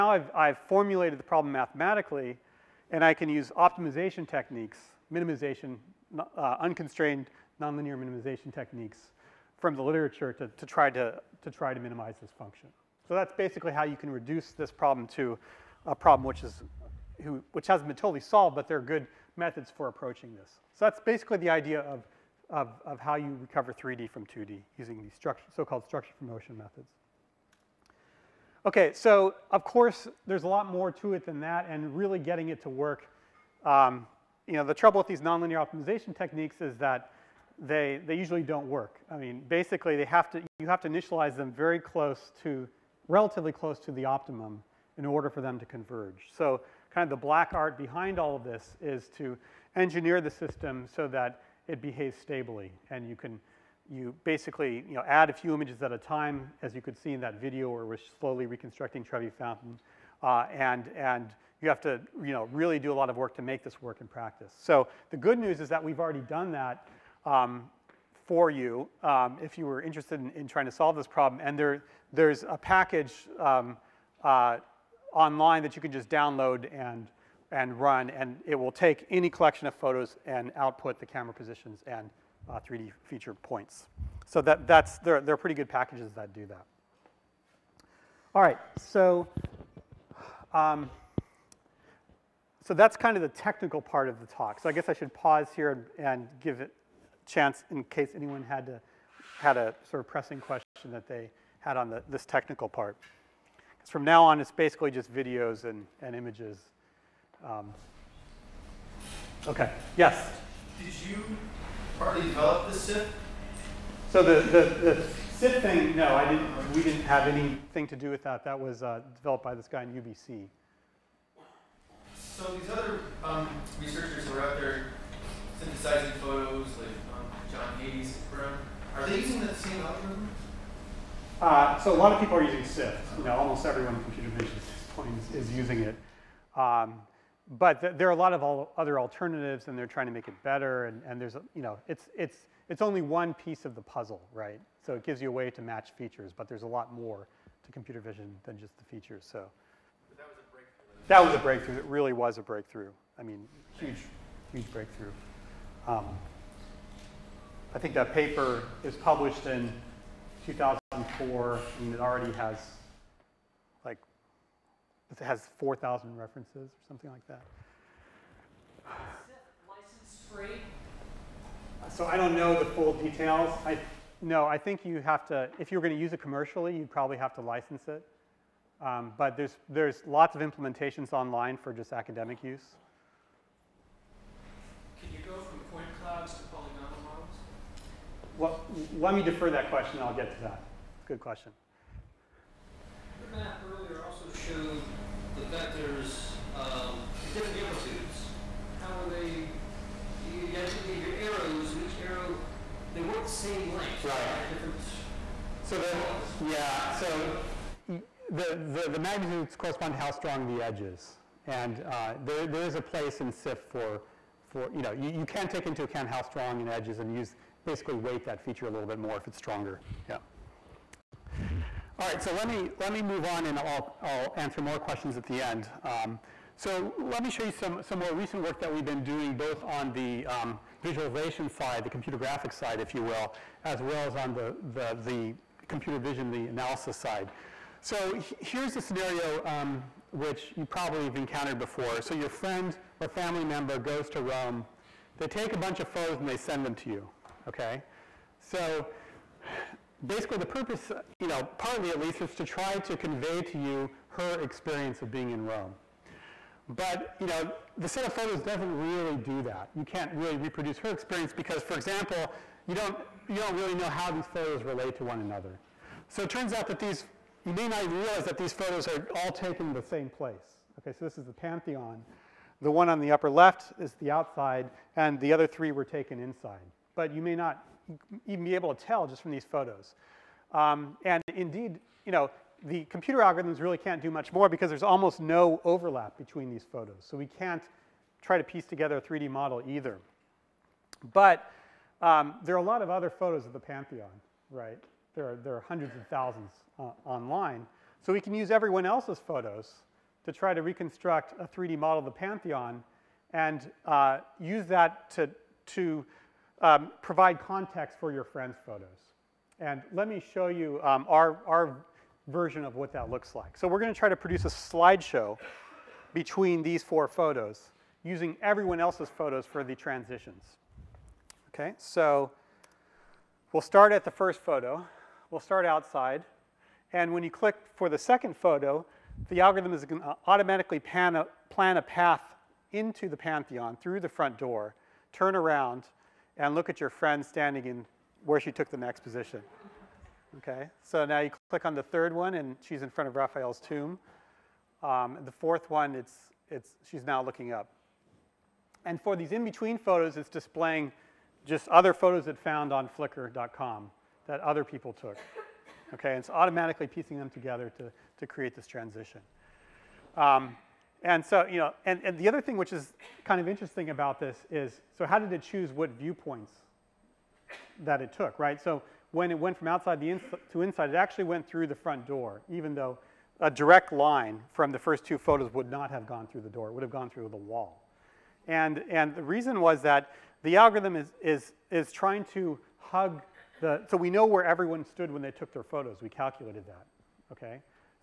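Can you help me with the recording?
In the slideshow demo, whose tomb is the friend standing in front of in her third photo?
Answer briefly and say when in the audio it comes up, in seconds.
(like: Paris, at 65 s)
Raphael, at 343 s.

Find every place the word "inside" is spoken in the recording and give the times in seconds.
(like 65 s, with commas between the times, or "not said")
276 s, 370 s.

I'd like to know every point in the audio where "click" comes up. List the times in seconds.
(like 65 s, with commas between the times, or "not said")
327 s, 341 s.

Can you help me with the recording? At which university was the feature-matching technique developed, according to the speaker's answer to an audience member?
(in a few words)
UBC.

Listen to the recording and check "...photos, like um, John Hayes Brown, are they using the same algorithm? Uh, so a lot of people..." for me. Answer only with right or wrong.
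right.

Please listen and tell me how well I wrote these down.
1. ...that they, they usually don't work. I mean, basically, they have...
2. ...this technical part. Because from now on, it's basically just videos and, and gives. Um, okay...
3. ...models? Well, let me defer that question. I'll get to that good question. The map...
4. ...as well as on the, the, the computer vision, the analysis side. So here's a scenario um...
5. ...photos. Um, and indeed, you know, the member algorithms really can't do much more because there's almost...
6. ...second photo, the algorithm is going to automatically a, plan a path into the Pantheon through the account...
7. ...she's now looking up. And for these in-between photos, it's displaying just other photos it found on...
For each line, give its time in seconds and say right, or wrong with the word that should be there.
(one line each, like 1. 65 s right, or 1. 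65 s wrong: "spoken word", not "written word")
1. 36 s right
2. 102 s wrong: "images", not "gives"
3. 187 s right
4. 233 s right
5. 279 s wrong: "computer", not "member"
6. 327 s wrong: "front", not "account"
7. 346 s right.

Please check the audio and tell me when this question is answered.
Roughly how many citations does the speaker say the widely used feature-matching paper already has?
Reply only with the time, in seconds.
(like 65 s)
165 s.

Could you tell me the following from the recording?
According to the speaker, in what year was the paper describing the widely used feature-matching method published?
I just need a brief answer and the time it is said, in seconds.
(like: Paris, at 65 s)
2000, at 160 s.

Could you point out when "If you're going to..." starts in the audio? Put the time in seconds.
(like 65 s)
175 s.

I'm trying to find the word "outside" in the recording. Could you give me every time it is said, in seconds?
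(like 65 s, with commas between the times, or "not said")
274 s, 325 s, 369 s.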